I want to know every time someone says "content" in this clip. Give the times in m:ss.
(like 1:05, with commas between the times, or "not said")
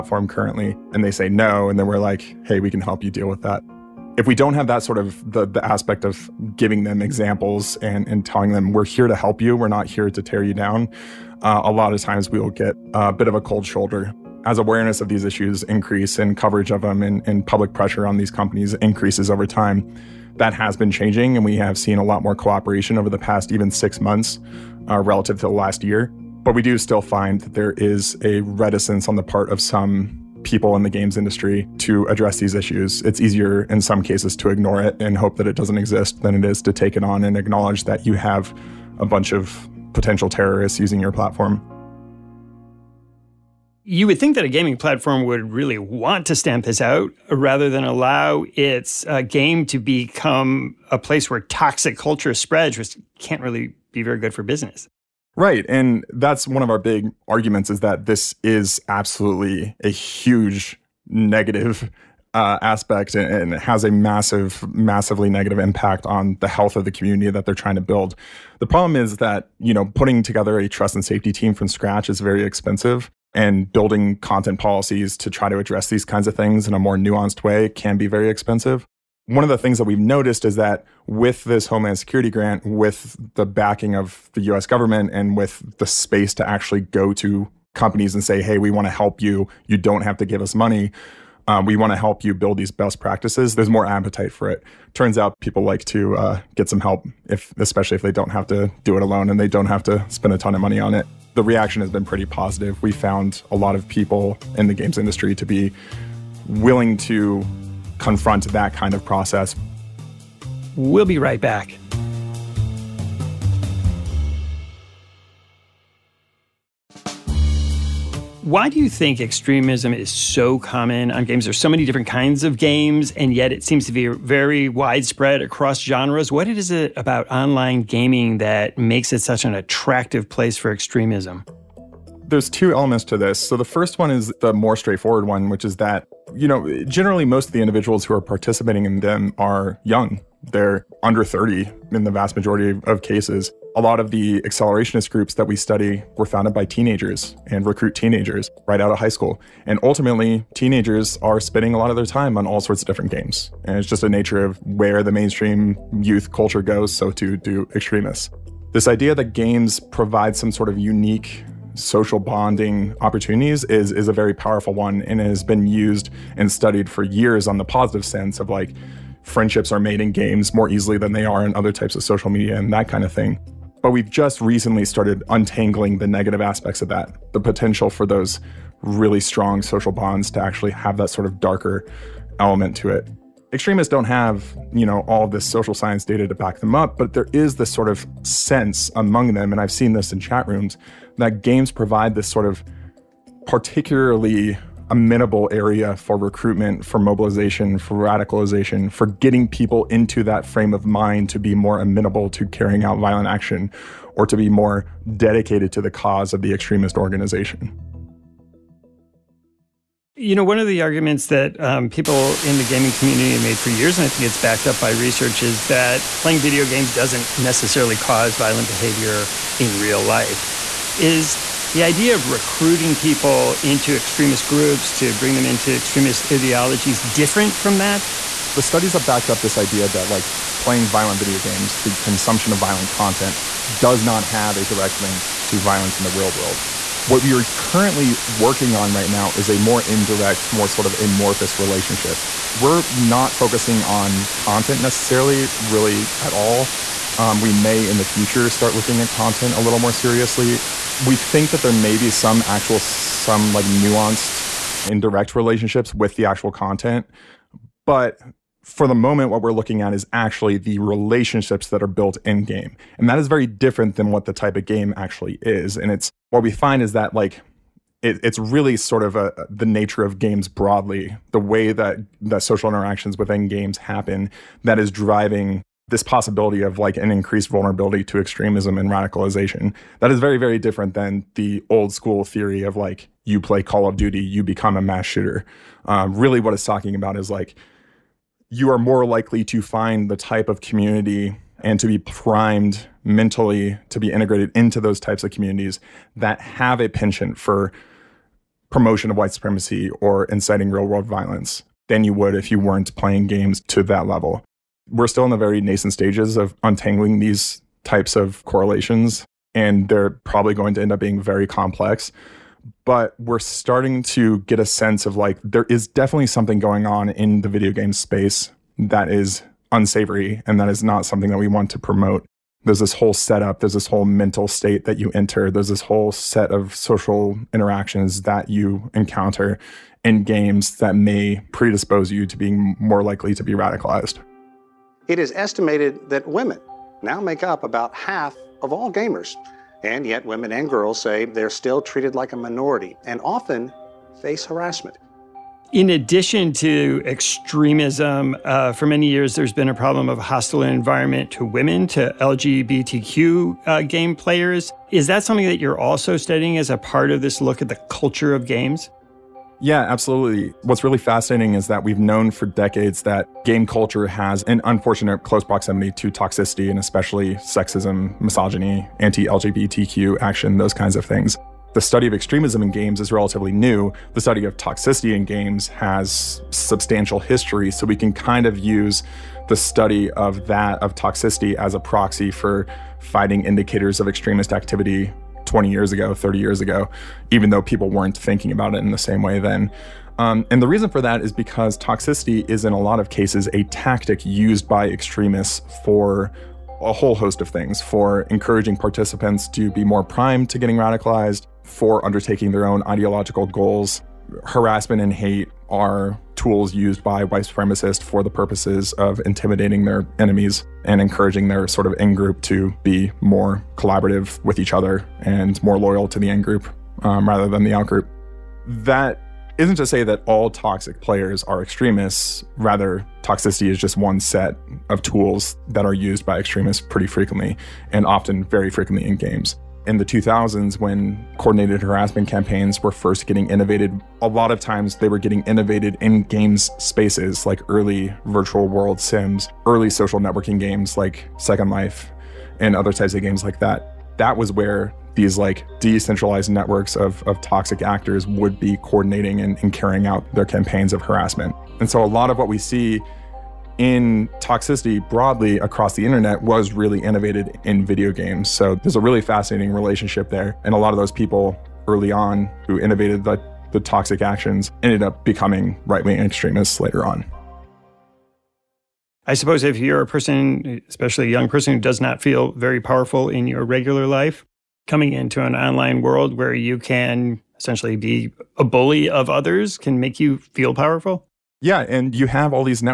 1:14, 3:52, 4:04, 4:09, 4:16.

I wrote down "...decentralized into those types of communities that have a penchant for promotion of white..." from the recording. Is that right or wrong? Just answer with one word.
wrong.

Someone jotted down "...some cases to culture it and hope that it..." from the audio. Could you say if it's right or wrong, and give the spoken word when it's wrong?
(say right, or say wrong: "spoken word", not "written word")
wrong: "ignore", not "culture".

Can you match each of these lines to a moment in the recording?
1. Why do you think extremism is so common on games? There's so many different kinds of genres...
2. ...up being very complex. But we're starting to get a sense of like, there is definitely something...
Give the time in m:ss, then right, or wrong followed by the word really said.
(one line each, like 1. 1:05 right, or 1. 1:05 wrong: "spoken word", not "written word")
1. 1:58 wrong: "games", not "genres"
2. 5:10 right.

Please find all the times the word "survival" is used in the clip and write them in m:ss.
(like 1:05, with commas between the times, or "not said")
not said.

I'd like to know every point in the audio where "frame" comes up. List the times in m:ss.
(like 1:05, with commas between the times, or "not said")
3:20.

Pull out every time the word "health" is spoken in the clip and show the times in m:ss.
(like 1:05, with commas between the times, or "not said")
1:06.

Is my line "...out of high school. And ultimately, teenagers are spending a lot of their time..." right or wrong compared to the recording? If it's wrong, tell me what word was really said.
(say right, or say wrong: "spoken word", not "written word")
right.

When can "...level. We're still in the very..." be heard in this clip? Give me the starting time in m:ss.
5:04.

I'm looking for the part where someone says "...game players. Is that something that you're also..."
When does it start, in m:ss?
5:53.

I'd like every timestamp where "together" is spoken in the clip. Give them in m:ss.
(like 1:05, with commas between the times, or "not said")
1:10.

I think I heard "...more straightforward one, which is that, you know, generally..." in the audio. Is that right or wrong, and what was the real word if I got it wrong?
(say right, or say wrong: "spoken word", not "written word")
right.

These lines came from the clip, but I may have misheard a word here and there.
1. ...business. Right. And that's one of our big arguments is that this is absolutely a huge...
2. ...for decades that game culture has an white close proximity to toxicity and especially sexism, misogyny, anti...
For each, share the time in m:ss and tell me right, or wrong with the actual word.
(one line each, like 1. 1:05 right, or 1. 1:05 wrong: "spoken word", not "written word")
1. 0:54 right
2. 6:02 wrong: "unfortunate", not "white".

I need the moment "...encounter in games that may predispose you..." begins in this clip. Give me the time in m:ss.
5:28.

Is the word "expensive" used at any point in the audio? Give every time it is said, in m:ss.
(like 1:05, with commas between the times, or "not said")
1:12, 1:18.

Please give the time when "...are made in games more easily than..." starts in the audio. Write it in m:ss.
2:49.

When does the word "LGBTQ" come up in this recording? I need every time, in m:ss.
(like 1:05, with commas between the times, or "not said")
5:52, 6:09.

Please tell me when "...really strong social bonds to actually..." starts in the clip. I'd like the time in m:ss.
2:58.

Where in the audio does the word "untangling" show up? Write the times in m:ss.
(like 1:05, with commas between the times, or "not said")
2:55, 5:06.